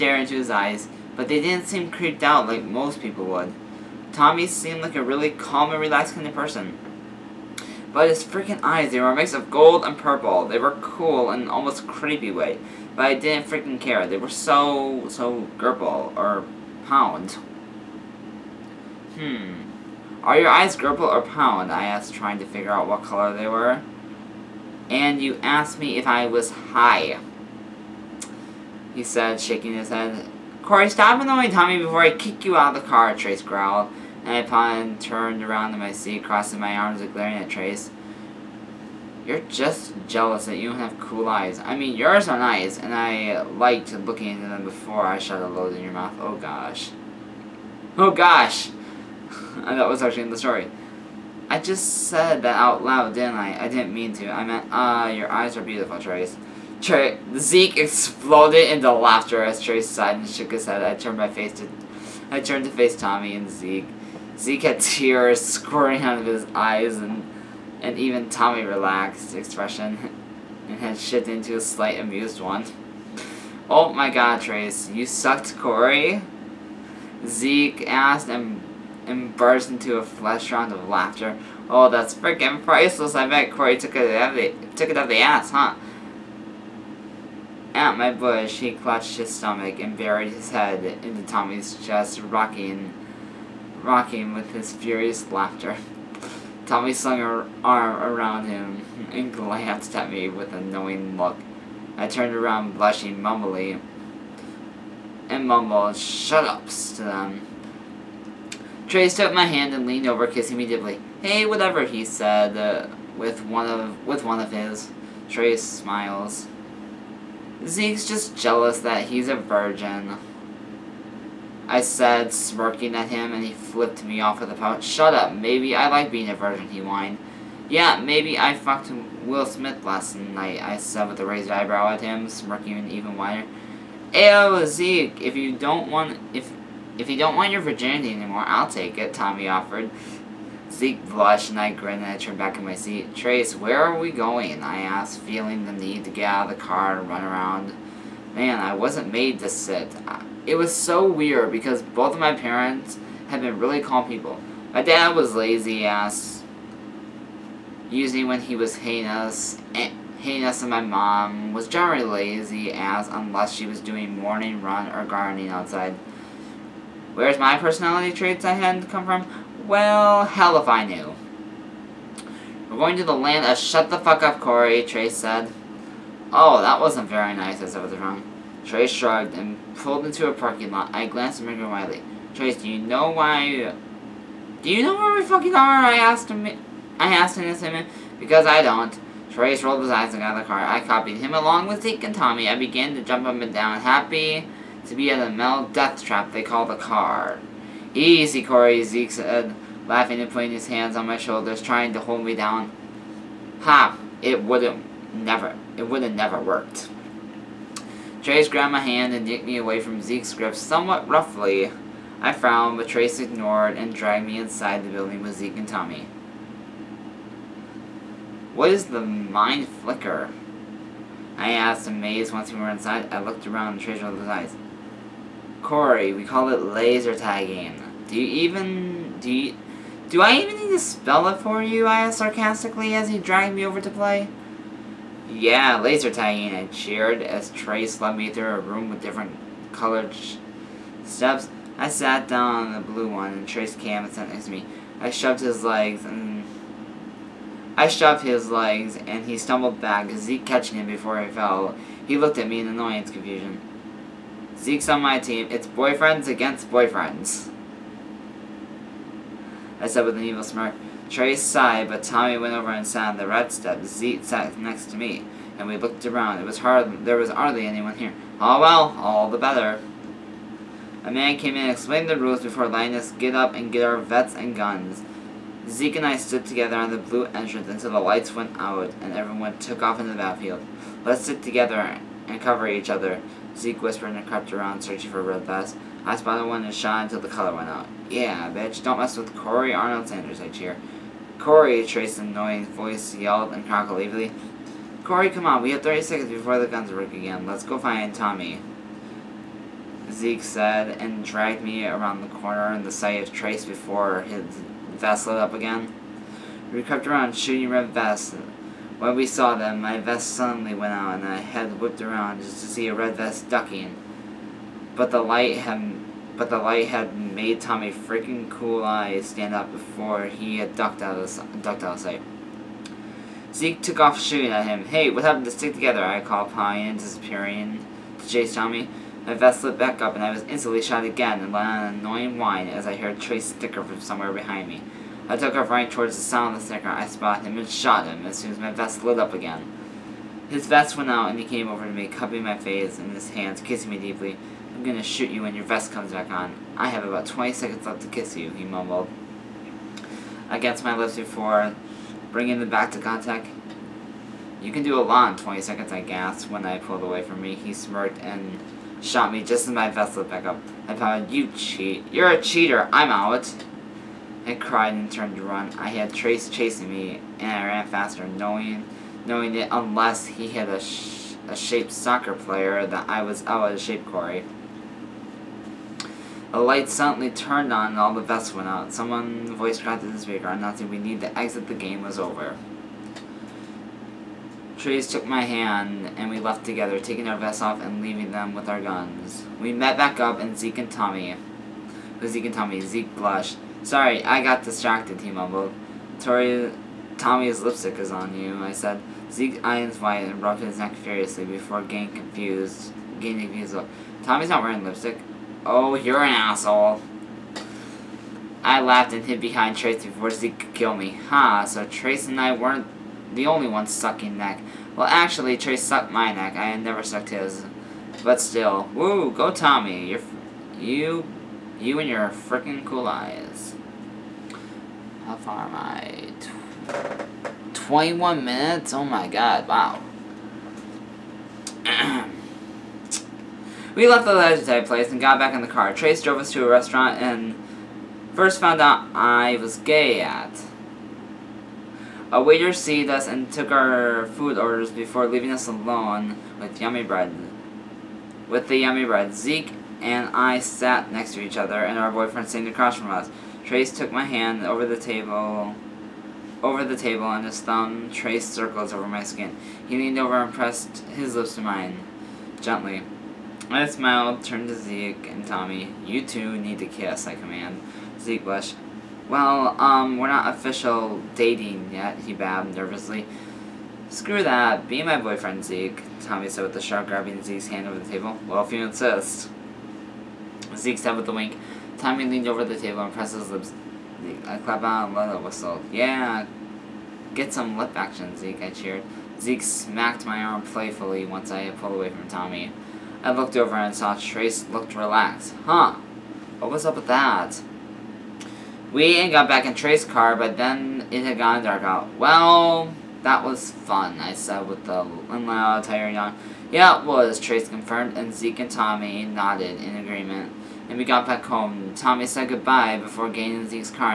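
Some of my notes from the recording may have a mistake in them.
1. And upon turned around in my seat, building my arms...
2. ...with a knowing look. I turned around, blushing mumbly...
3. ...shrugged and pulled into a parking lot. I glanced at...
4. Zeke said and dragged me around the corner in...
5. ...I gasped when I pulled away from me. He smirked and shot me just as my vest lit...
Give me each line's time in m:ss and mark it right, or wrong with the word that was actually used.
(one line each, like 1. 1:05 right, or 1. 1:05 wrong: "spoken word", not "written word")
1. 0:34 wrong: "crossing", not "building"
2. 1:40 right
3. 2:58 right
4. 5:00 right
5. 5:55 right.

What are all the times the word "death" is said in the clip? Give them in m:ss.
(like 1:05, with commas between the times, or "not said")
3:15.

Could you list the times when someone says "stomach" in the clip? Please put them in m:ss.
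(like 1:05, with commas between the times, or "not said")
1:29.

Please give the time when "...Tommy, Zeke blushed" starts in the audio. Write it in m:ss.
6:32.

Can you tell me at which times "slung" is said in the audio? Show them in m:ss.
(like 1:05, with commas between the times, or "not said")
1:36.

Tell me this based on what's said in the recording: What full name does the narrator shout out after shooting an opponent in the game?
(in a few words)
Corey Arnold Sanders.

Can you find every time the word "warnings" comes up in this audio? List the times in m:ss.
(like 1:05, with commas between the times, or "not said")
not said.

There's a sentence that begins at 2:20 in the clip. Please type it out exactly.
Zeke blushed and I grinned and I turned back in my seat.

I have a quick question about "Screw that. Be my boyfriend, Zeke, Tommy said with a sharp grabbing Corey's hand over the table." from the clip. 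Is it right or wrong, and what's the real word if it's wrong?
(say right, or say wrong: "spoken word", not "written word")
wrong: "Zeke", not "Corey".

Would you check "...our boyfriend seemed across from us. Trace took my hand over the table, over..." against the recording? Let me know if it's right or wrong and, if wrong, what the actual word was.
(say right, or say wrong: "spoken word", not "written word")
right.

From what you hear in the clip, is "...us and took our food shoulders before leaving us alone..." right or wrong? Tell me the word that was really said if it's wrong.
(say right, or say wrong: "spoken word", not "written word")
wrong: "orders", not "shoulders".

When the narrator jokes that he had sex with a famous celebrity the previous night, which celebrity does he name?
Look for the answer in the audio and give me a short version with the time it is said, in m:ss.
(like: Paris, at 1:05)
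Will Smith, at 2:09.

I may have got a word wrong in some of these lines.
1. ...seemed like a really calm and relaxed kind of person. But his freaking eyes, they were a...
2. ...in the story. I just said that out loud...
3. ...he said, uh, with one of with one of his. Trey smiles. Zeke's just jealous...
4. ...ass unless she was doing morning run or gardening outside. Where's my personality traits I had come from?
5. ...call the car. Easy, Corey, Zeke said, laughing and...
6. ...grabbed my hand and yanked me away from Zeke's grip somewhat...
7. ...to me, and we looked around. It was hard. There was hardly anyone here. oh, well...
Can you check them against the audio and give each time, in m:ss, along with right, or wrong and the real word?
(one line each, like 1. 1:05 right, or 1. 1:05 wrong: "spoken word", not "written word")
1. 0:04 right
2. 0:50 right
3. 1:51 right
4. 2:42 right
5. 3:16 right
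6. 3:28 right
7. 4:24 right.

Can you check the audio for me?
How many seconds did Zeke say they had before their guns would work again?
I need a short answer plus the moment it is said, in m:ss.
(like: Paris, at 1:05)
30, at 4:55.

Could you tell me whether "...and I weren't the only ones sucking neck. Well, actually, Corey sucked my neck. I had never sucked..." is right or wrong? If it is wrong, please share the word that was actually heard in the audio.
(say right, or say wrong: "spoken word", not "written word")
wrong: "Trace", not "Corey".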